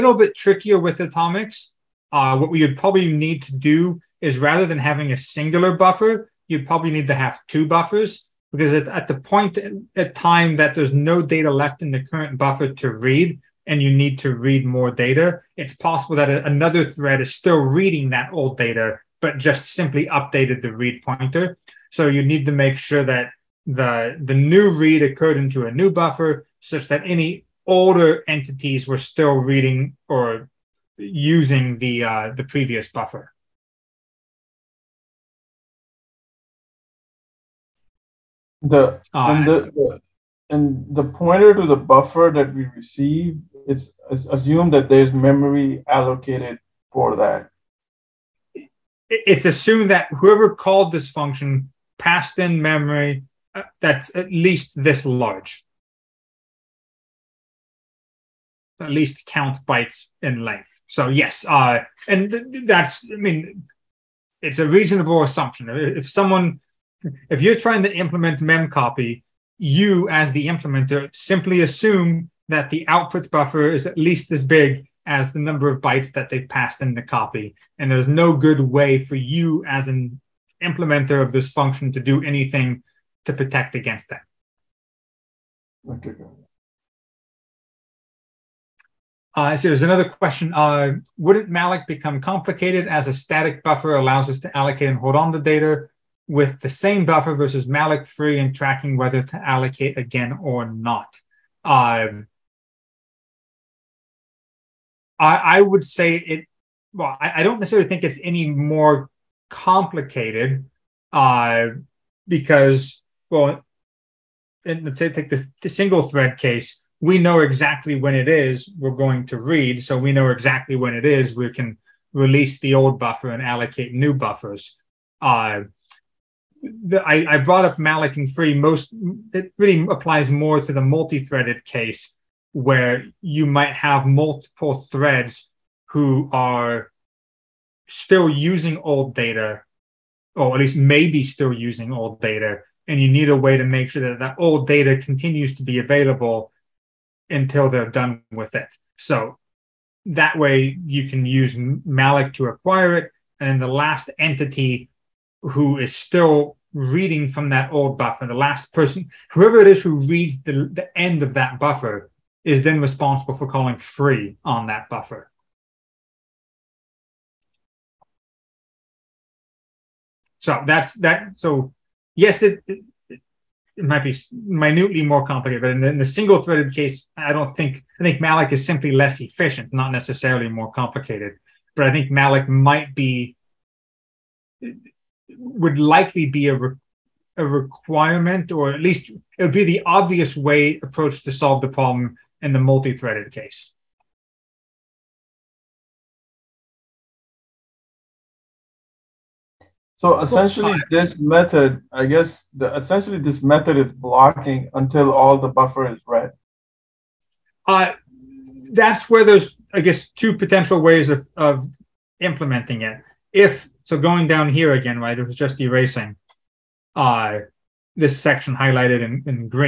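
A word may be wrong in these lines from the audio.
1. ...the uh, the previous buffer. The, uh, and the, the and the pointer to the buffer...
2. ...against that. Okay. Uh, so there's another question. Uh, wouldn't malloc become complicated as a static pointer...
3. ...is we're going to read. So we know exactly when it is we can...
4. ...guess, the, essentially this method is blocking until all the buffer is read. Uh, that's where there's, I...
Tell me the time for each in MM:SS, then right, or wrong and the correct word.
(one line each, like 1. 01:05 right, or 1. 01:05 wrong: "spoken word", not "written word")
1. 00:31 right
2. 01:23 wrong: "buffer", not "pointer"
3. 01:58 right
4. 03:22 right.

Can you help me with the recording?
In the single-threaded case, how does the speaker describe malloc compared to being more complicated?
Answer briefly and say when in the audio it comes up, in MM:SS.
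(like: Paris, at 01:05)
less efficient, at 02:58.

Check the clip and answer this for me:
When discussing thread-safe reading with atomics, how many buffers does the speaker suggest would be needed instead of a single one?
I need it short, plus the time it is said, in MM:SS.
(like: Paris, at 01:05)
2, at 00:07.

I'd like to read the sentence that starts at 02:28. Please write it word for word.
So that way you can use malloc to acquire it.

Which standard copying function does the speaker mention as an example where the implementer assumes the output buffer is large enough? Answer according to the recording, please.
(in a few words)
memcopy.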